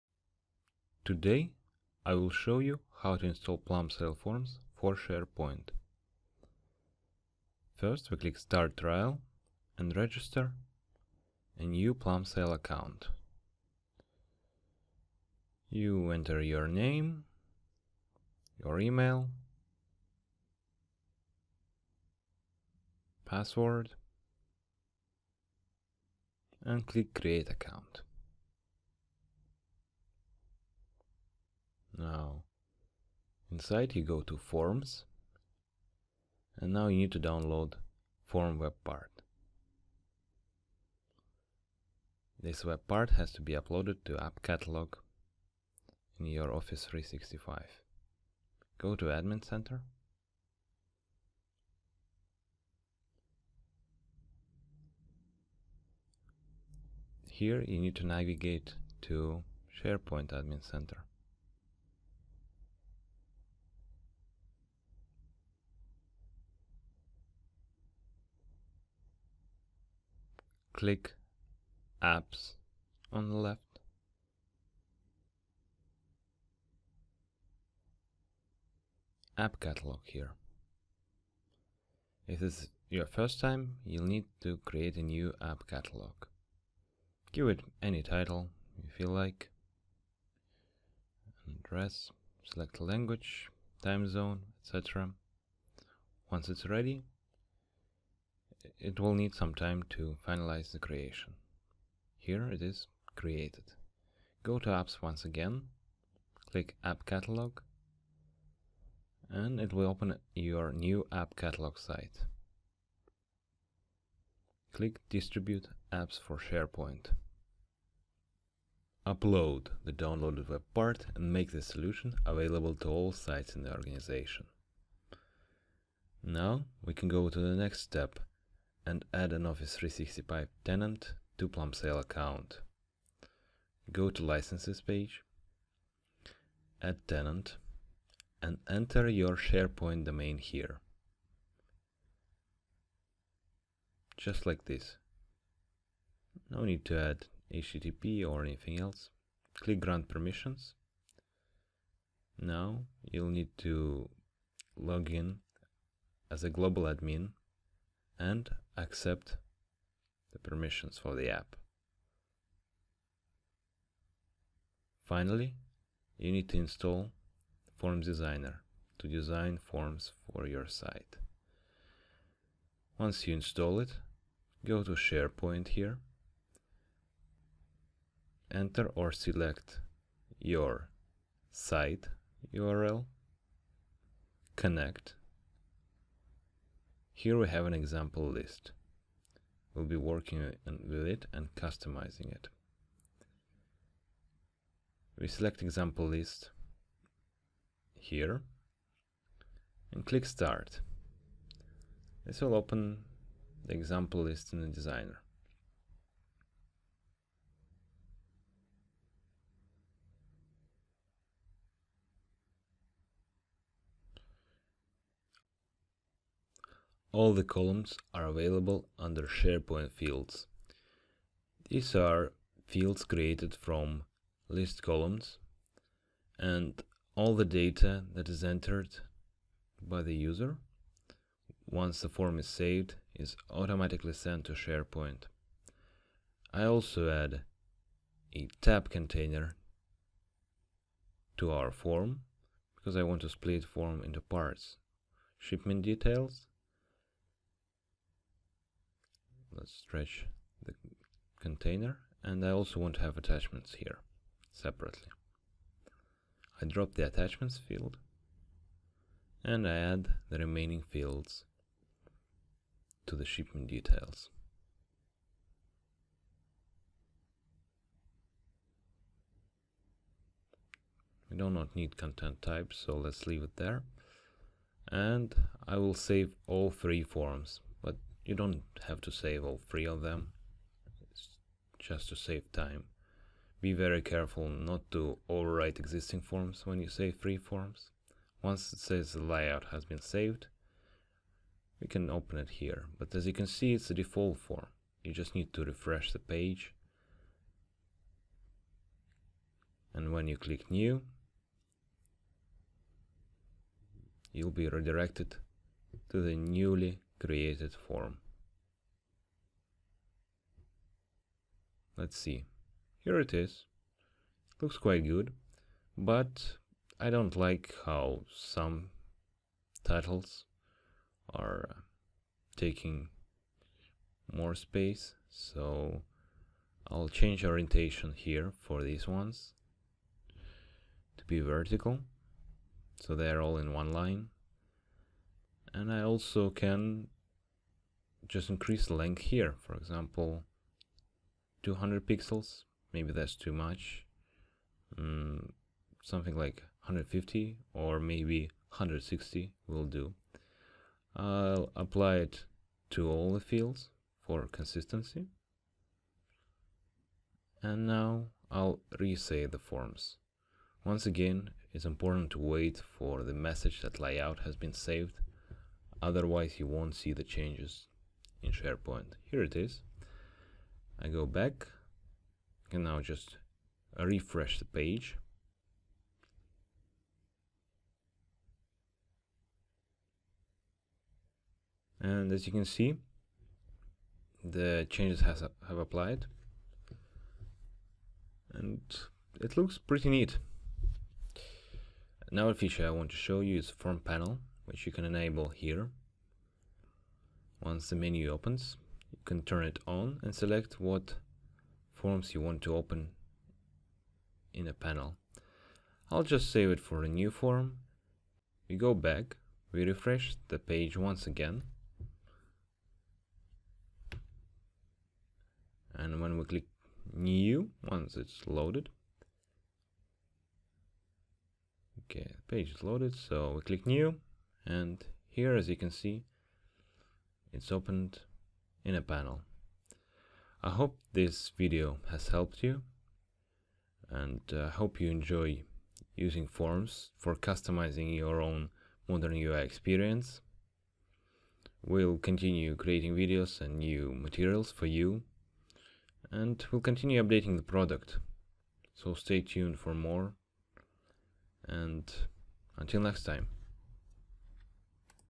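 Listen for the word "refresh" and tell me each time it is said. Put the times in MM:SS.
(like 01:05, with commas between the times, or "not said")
04:55, 06:13, 06:49.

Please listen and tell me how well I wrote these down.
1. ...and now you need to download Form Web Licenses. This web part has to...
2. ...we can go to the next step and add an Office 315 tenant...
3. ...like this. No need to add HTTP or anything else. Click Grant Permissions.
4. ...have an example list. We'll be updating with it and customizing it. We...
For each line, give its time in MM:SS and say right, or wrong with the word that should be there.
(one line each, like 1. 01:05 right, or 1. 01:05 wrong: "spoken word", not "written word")
1. 00:36 wrong: "Part", not "Licenses"
2. 02:06 wrong: "365", not "315"
3. 02:24 right
4. 03:07 wrong: "working", not "updating".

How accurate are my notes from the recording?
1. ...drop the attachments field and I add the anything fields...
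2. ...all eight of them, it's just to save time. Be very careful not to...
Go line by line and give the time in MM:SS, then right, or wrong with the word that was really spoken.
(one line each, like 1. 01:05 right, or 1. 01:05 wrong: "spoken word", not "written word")
1. 04:16 wrong: "remaining", not "anything"
2. 04:39 wrong: "three", not "eight".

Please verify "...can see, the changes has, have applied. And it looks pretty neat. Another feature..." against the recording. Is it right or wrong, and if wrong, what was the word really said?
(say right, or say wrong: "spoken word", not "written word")
right.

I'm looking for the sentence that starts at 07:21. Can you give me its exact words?
We'll continue creating videos and new materials for you and we'll continue updating the product.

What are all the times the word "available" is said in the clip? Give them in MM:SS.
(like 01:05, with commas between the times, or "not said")
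02:02, 03:38.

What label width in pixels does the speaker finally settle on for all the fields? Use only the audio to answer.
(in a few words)
160.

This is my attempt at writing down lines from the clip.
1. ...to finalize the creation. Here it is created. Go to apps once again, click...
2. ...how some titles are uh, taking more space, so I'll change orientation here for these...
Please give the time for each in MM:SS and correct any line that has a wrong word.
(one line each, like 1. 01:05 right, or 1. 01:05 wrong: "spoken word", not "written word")
1. 01:39 right
2. 05:17 right.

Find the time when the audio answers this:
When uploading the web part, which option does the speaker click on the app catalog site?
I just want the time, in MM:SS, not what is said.
01:55.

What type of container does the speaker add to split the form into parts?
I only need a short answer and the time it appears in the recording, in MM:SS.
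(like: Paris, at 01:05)
Tab container, at 03:58.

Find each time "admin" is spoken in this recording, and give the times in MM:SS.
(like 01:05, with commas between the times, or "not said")
00:49, 01:00, 02:36.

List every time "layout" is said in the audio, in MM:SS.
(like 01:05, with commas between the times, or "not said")
04:49, 06:03.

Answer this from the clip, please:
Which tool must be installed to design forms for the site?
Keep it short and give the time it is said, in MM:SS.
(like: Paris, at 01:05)
Forms Designer, at 02:47.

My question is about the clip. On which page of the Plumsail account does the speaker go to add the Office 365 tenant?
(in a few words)
Licenses.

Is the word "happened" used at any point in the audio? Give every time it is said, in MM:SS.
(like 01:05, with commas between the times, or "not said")
not said.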